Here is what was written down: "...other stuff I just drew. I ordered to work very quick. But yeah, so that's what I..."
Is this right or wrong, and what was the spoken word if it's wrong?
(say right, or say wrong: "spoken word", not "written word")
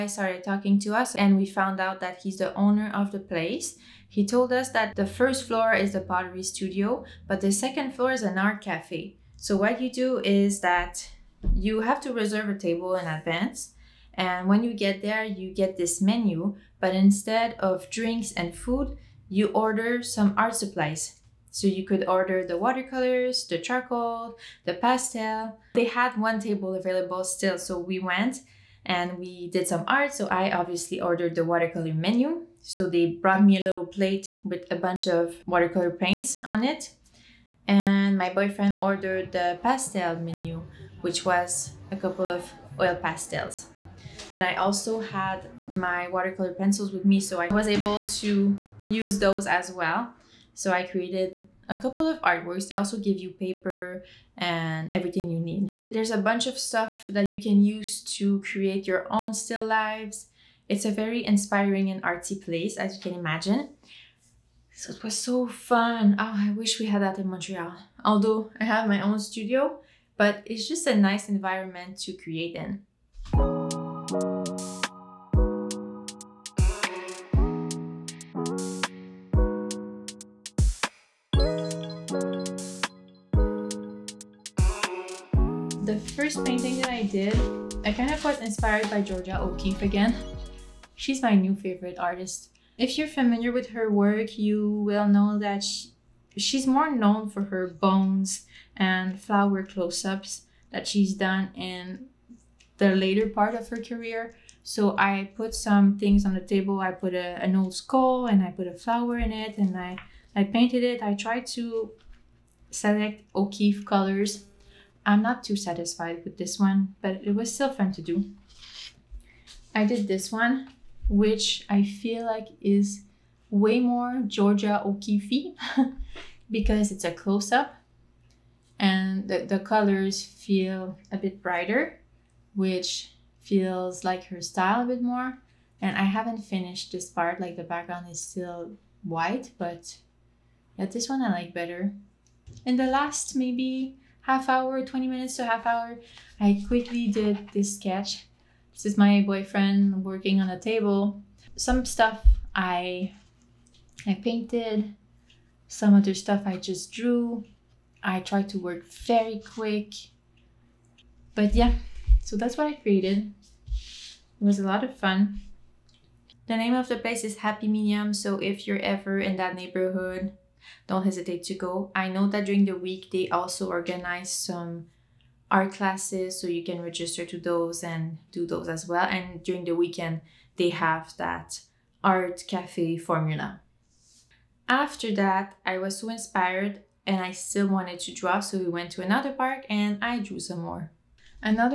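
wrong: "tried", not "ordered".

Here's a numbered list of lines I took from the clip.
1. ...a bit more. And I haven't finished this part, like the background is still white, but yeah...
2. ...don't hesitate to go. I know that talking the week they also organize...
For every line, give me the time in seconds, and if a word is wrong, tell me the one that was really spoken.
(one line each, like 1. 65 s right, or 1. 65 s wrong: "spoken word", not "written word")
1. 134 s right
2. 170 s wrong: "during", not "talking".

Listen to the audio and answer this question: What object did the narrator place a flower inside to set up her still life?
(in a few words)
An old skull.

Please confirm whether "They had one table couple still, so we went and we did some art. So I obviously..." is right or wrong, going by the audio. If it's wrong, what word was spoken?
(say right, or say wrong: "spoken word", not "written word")
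wrong: "available", not "couple".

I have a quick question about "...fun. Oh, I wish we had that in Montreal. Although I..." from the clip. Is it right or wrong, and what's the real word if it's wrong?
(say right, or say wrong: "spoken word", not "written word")
right.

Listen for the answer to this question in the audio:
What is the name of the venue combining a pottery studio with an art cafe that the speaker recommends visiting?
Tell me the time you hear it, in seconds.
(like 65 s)
167 s.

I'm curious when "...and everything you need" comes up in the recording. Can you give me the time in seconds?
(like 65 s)
54 s.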